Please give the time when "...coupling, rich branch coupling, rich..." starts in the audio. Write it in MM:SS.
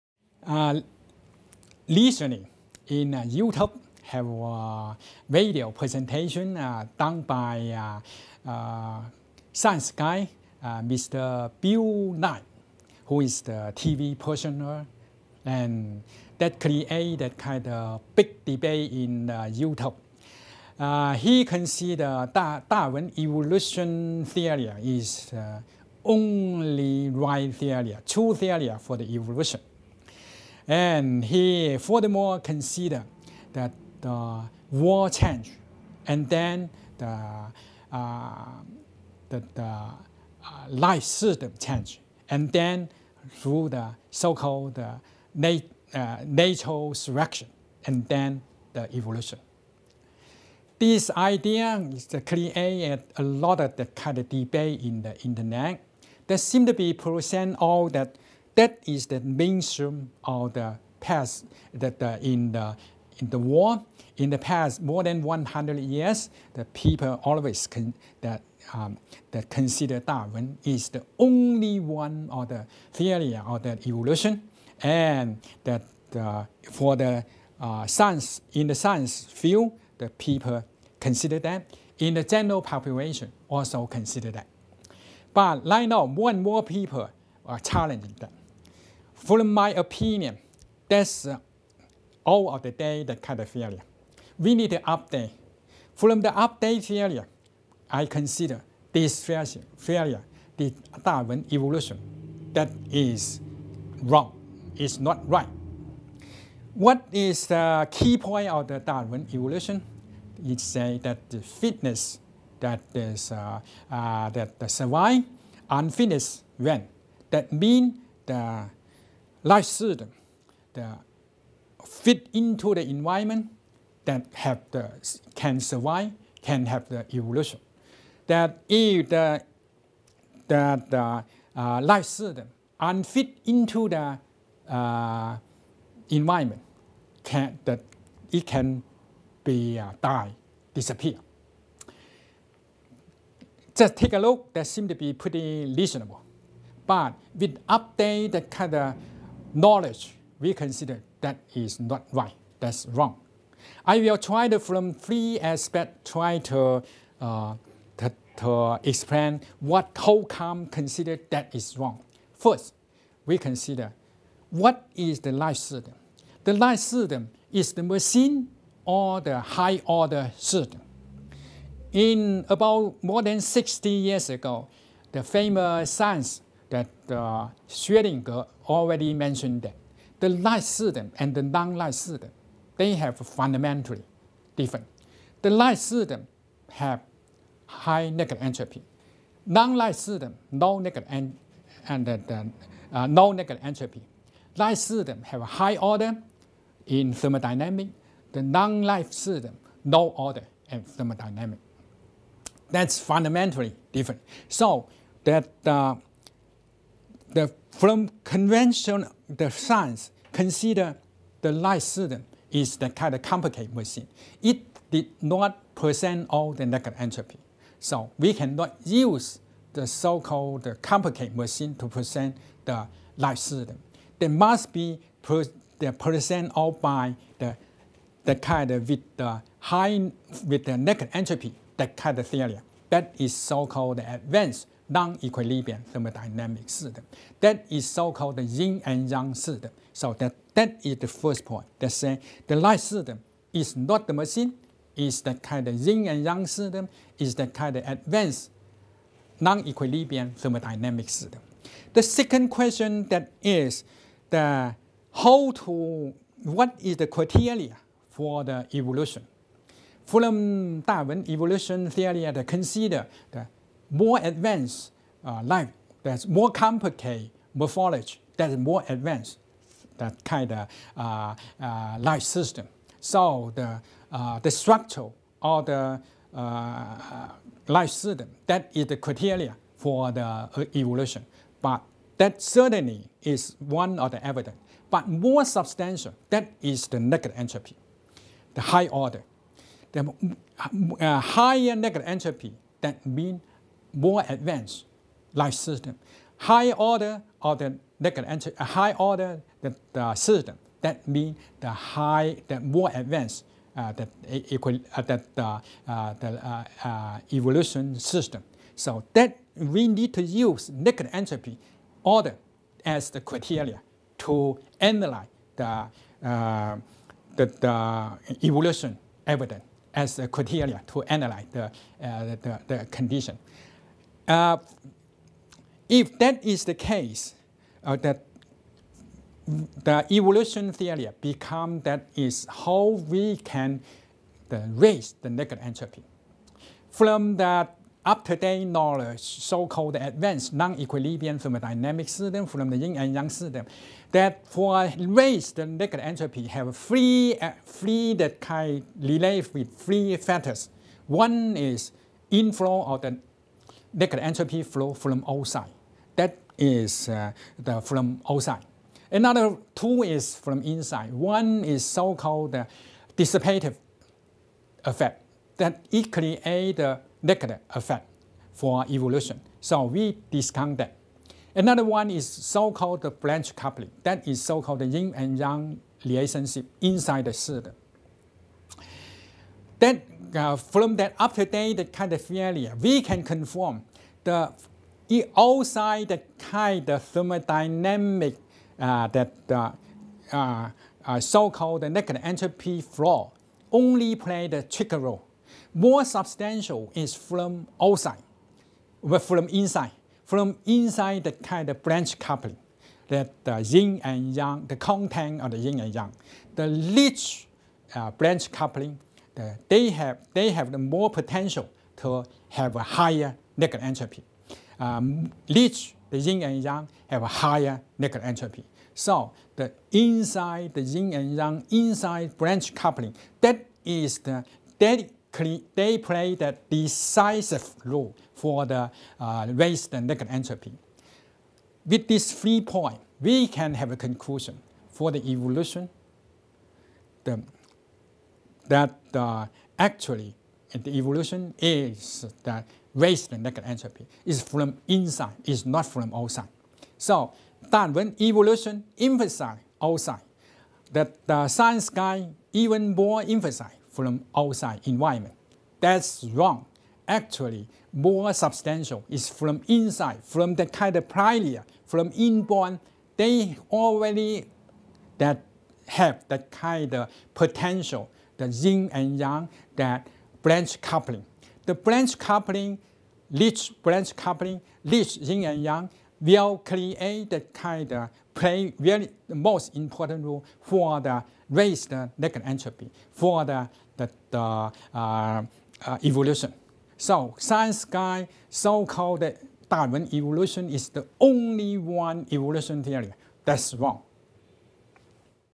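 07:52.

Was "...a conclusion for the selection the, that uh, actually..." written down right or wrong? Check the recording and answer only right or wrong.
wrong.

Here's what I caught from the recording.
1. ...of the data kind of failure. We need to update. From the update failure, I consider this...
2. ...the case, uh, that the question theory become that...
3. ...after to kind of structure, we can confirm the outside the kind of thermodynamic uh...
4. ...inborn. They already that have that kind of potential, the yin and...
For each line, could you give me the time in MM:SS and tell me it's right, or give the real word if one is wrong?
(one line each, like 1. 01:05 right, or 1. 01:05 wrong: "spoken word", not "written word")
1. 01:32 right
2. 05:26 wrong: "evolution", not "question"
3. 06:21 wrong: "failure", not "structure"
4. 07:42 right.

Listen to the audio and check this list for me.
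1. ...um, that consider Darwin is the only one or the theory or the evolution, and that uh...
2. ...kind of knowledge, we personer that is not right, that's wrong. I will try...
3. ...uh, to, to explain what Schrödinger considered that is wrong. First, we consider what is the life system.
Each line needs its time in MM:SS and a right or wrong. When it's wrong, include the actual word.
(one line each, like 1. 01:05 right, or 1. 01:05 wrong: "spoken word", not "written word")
1. 01:08 right
2. 02:28 wrong: "consider", not "personer"
3. 02:37 wrong: "Holcomb", not "Schrödinger".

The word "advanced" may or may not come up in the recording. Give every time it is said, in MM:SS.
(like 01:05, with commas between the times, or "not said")
03:53, 04:07, 04:24, 04:28, 04:54, 05:02, 05:39.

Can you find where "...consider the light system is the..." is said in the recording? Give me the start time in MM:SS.
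03:30.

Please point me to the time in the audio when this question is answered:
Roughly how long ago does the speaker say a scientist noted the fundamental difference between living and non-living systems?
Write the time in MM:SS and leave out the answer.
02:53.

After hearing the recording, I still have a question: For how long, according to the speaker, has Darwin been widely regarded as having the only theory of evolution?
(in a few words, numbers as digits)
More than 100 years.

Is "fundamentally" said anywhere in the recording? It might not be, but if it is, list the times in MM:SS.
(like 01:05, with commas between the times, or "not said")
03:03, 03:22.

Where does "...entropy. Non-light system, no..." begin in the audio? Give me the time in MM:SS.
03:08.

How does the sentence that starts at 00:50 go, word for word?
This idea is created a lot of the kind of debate in the internet.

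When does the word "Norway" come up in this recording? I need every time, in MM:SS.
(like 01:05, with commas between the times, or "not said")
not said.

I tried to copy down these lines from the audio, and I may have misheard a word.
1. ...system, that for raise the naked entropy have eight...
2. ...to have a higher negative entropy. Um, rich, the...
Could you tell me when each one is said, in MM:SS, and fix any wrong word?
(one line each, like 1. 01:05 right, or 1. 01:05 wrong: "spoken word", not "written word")
1. 05:43 wrong: "three", not "eight"
2. 06:51 right.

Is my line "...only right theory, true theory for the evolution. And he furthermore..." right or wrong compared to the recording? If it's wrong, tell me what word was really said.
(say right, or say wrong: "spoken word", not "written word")
right.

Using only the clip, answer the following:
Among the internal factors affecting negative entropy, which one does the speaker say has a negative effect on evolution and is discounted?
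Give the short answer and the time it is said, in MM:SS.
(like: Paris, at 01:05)
Dissipative effect, at 06:03.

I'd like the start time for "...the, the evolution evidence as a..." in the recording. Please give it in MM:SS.
05:16.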